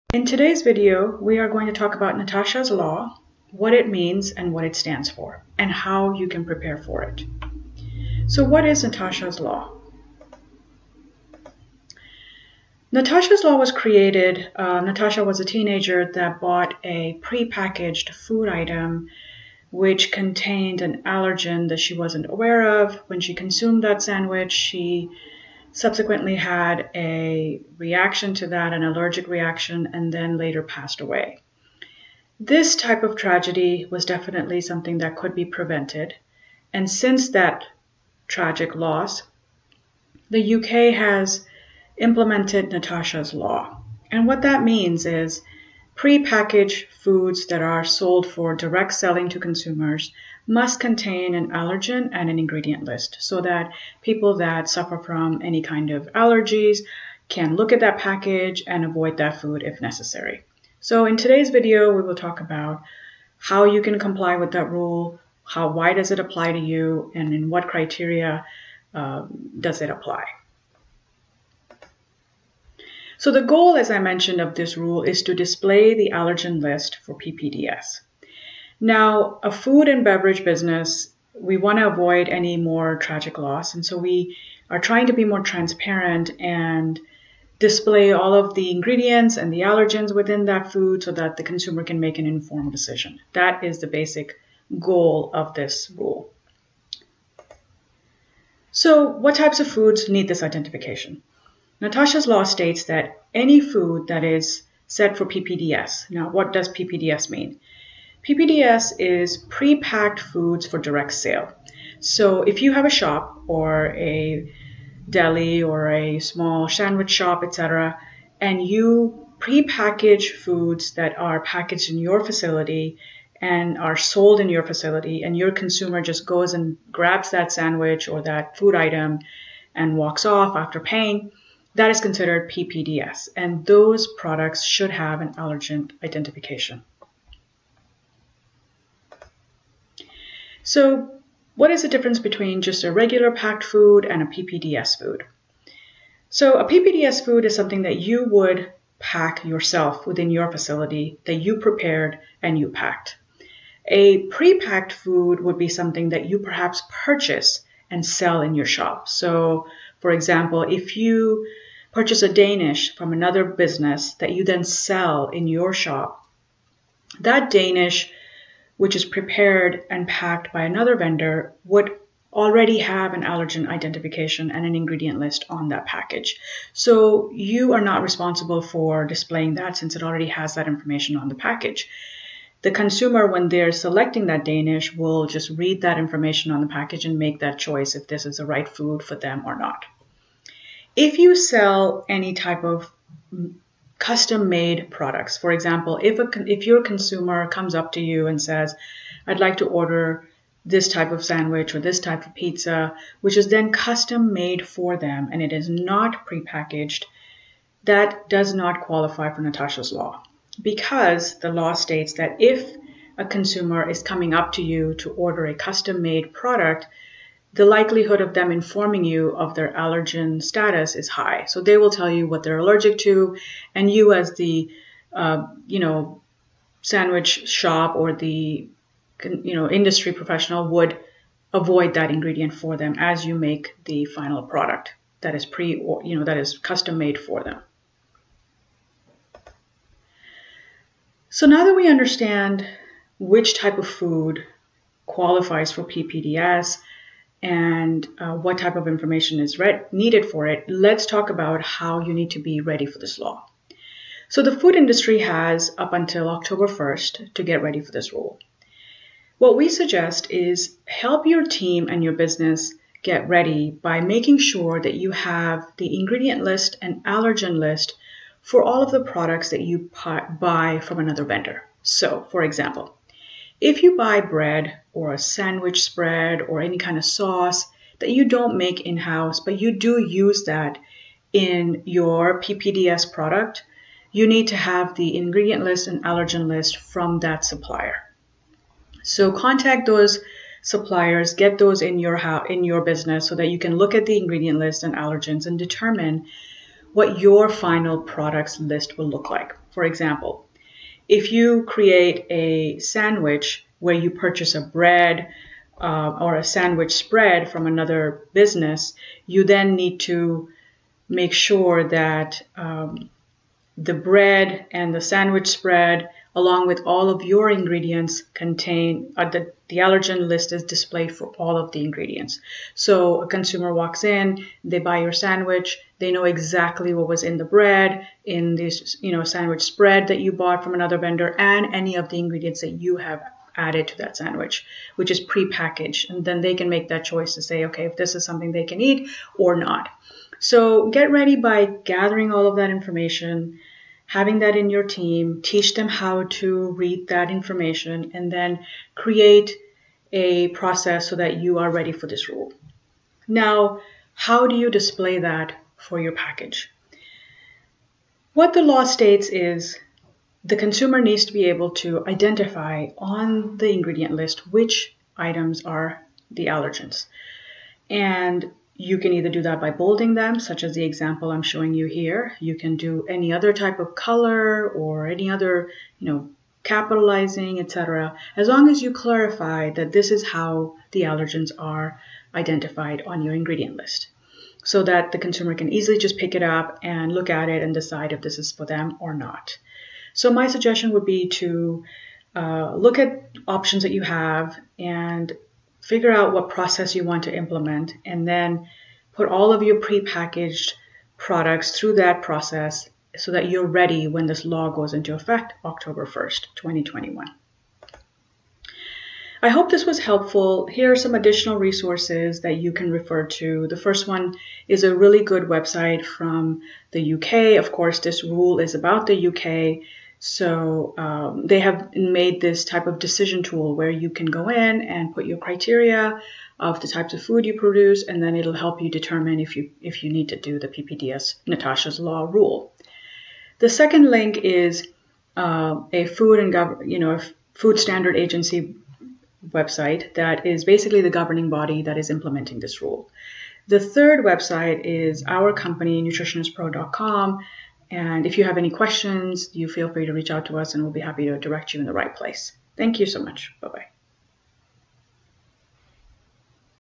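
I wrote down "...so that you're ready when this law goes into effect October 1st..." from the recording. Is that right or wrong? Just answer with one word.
right.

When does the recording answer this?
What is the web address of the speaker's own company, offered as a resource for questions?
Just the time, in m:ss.
7:26.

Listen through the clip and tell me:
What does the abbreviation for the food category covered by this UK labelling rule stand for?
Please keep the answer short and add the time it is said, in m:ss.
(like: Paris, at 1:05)
Pre-packed foods for direct sale, at 1:49.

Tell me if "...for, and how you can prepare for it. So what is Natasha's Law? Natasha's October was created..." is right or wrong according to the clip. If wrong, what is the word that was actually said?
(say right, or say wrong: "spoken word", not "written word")
wrong: "Law", not "October".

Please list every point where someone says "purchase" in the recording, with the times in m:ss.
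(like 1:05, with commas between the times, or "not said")
2:37, 2:41, 5:04.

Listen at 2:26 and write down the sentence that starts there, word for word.
So a PPDS food is something that you would pack yourself within your facility that you prepared and you packed.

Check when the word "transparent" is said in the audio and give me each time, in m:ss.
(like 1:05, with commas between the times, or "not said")
1:25.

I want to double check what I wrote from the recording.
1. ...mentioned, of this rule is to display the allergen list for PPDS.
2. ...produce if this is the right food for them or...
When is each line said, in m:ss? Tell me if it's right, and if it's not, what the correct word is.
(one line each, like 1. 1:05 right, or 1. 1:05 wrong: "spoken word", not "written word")
1. 1:13 right
2. 3:07 wrong: "choice", not "produce".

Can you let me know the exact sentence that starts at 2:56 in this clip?
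So you are not responsible for displaying that since it already has that information on the package.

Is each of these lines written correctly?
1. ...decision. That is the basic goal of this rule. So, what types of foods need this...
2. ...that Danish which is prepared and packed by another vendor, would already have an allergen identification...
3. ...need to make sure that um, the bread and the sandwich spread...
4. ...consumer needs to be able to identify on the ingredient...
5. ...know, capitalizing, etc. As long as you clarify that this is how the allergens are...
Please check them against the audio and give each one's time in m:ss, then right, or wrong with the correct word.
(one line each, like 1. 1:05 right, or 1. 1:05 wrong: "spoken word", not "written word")
1. 1:32 right
2. 2:47 right
3. 5:09 right
4. 6:00 right
5. 6:16 right.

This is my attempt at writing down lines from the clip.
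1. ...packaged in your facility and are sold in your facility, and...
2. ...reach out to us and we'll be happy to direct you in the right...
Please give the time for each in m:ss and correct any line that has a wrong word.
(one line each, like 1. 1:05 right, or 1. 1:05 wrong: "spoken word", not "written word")
1. 2:01 right
2. 7:30 right.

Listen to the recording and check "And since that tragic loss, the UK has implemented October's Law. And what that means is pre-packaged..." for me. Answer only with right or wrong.
wrong.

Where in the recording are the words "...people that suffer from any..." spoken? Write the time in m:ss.
0:54.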